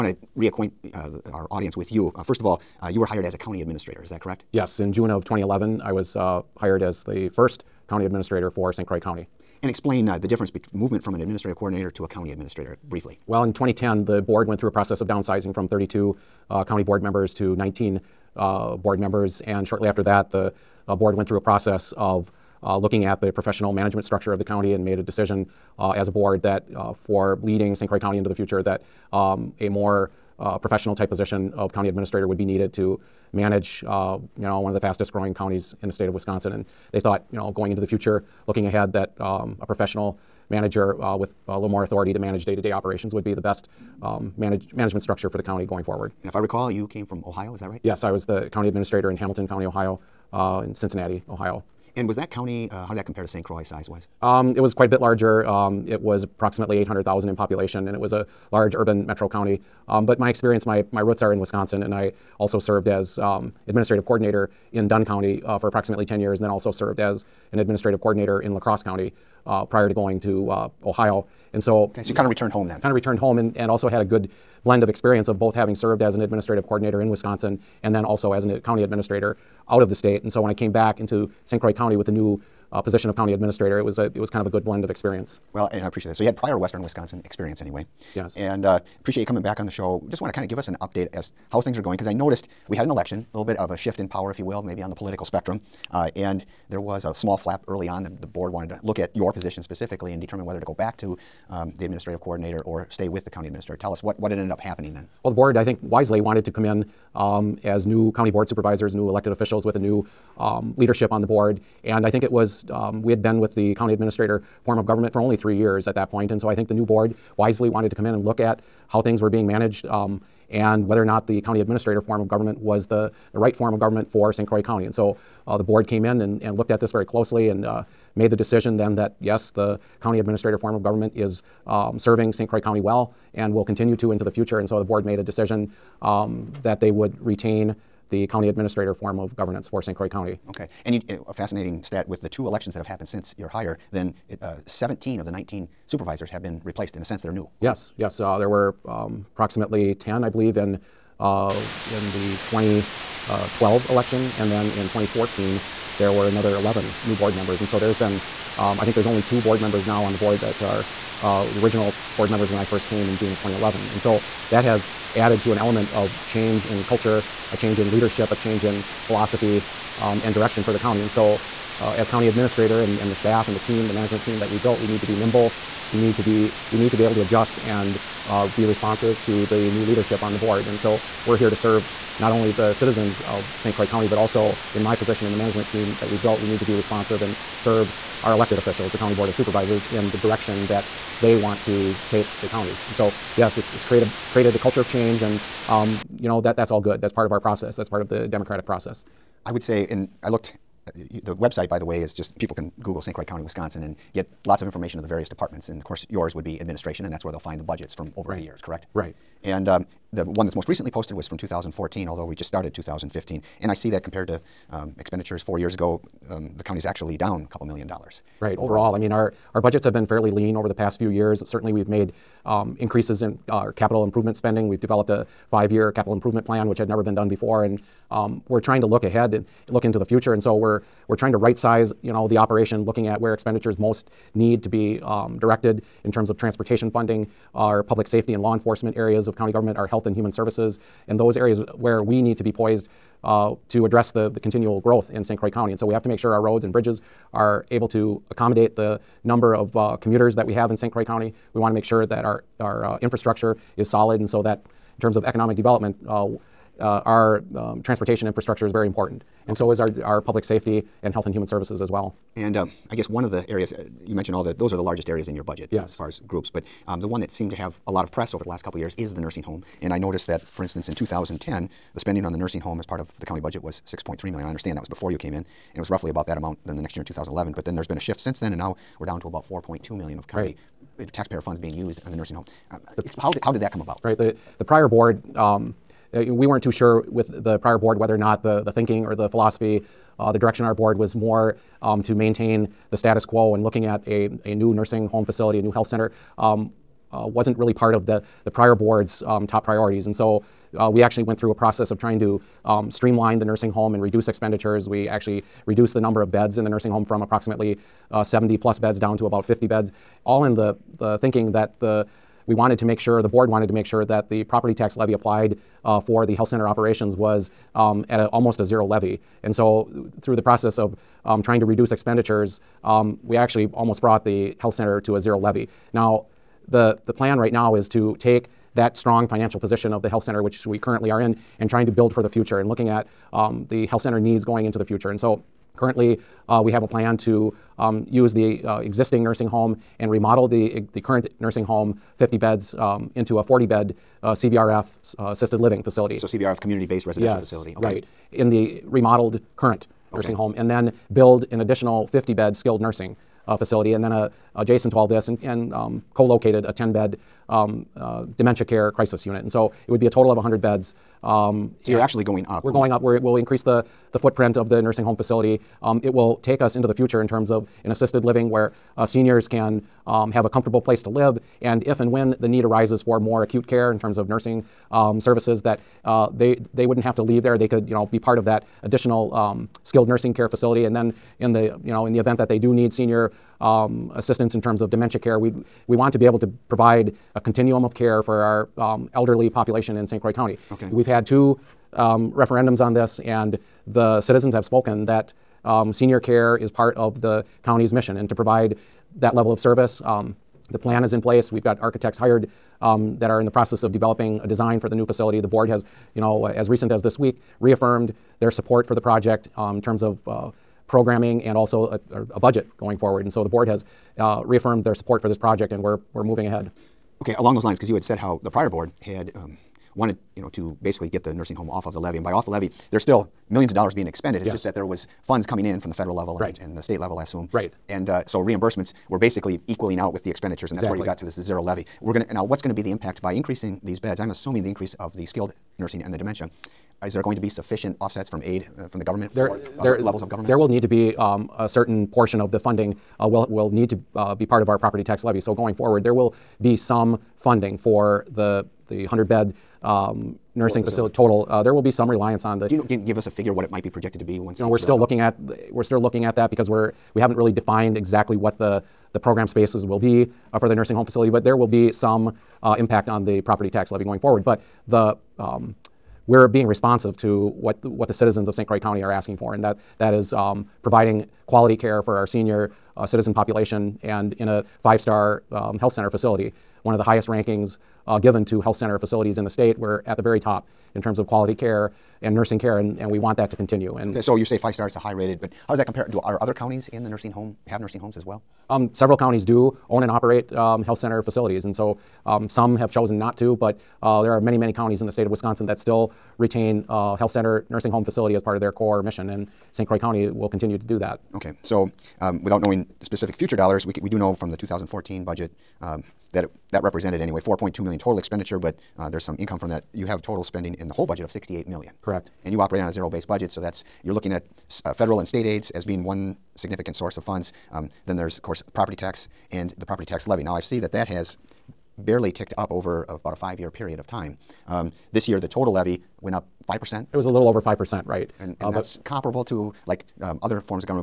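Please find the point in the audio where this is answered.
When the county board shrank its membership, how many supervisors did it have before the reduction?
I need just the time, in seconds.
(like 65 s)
15 s.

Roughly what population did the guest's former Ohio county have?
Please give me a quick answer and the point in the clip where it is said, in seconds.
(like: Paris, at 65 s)
800,000, at 56 s.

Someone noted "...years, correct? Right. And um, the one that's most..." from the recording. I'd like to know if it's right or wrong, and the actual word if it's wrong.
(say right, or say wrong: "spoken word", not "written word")
right.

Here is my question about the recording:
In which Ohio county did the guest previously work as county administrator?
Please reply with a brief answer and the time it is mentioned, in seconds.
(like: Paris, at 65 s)
Hamilton County, at 49 s.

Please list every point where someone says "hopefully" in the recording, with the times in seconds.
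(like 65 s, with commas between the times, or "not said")
not said.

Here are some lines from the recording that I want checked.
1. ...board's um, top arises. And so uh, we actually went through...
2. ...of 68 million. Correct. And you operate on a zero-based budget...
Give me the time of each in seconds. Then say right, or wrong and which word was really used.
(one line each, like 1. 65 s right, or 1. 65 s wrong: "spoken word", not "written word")
1. 298 s wrong: "priorities", not "arises"
2. 511 s right.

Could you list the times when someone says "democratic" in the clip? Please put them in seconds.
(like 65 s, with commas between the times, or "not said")
198 s.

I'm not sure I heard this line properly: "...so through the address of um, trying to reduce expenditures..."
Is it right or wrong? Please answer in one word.
wrong.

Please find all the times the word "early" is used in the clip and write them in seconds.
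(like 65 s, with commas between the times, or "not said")
97 s.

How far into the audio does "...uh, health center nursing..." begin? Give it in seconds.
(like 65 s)
496 s.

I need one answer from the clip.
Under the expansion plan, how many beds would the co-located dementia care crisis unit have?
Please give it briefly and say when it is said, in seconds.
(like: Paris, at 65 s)
10, at 356 s.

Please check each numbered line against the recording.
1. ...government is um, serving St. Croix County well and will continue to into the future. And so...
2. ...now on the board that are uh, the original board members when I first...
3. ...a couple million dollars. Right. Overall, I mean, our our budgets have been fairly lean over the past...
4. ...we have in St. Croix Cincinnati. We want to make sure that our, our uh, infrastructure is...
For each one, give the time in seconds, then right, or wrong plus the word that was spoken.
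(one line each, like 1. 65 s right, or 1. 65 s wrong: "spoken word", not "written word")
1. 130 s right
2. 159 s right
3. 217 s right
4. 250 s wrong: "County", not "Cincinnati".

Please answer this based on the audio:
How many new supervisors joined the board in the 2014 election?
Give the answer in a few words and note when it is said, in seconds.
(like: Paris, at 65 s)
11, at 156 s.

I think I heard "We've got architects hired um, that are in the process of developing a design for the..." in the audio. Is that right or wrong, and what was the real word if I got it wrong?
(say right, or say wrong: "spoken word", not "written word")
right.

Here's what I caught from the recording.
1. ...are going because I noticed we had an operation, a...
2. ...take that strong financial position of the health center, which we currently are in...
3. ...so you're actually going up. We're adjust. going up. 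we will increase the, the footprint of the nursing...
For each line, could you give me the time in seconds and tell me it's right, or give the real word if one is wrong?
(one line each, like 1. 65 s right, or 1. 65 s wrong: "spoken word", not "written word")
1. 91 s wrong: "election", not "operation"
2. 328 s right
3. 361 s wrong: "almost", not "adjust".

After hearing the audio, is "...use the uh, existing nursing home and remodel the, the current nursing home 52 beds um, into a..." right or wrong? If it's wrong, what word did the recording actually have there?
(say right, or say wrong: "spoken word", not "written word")
wrong: "50", not "52".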